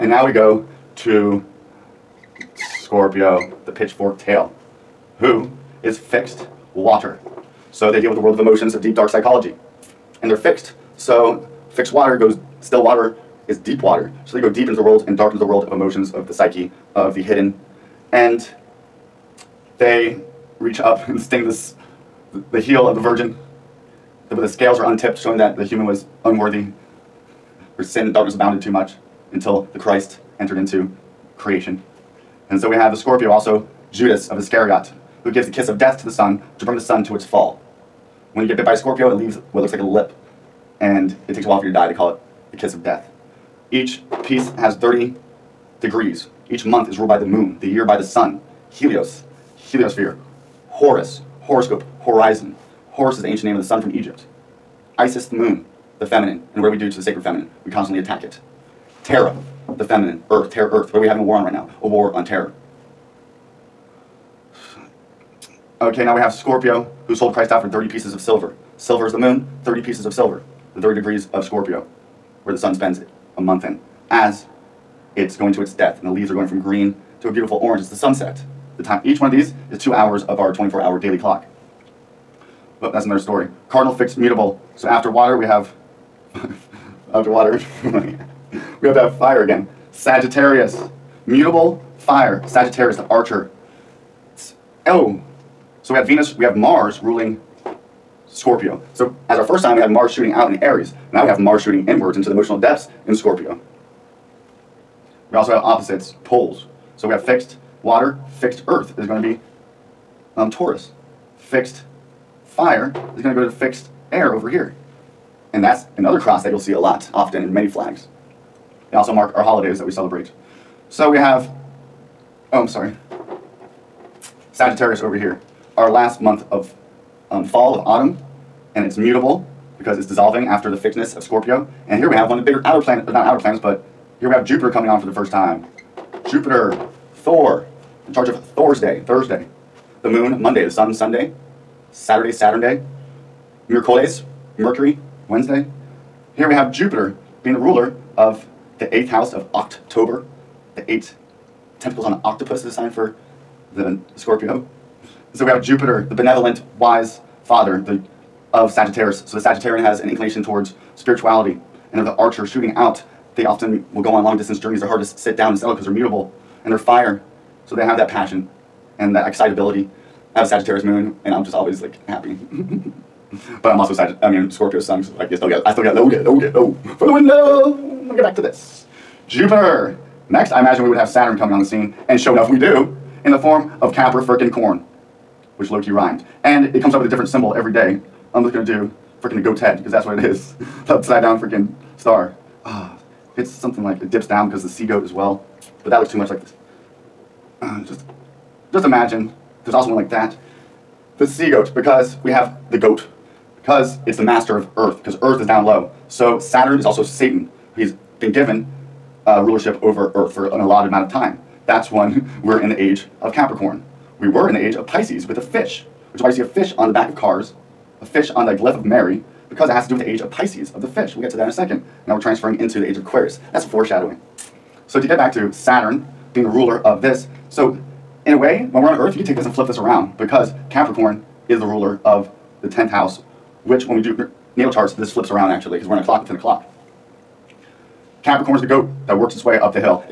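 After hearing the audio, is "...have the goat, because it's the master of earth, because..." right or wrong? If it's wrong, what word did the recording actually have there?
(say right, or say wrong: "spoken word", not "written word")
right.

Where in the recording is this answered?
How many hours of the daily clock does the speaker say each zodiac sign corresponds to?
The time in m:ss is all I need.
1:19.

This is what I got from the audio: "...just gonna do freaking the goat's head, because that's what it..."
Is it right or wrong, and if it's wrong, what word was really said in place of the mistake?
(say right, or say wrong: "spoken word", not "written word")
right.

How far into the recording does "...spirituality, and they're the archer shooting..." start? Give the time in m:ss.
2:40.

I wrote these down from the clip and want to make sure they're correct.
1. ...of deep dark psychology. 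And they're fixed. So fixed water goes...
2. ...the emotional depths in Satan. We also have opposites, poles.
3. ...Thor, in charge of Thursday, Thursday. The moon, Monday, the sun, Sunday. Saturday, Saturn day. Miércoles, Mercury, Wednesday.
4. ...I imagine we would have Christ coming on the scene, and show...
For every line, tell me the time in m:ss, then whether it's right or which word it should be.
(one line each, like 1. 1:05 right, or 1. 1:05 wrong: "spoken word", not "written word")
1. 0:08 right
2. 1:42 wrong: "Scorpio", not "Satan"
3. 2:17 right
4. 3:00 wrong: "Saturn", not "Christ".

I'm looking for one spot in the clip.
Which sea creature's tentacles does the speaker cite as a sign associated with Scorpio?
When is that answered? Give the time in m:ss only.
2:32.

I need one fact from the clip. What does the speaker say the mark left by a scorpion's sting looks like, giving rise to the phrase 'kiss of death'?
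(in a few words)
A lip.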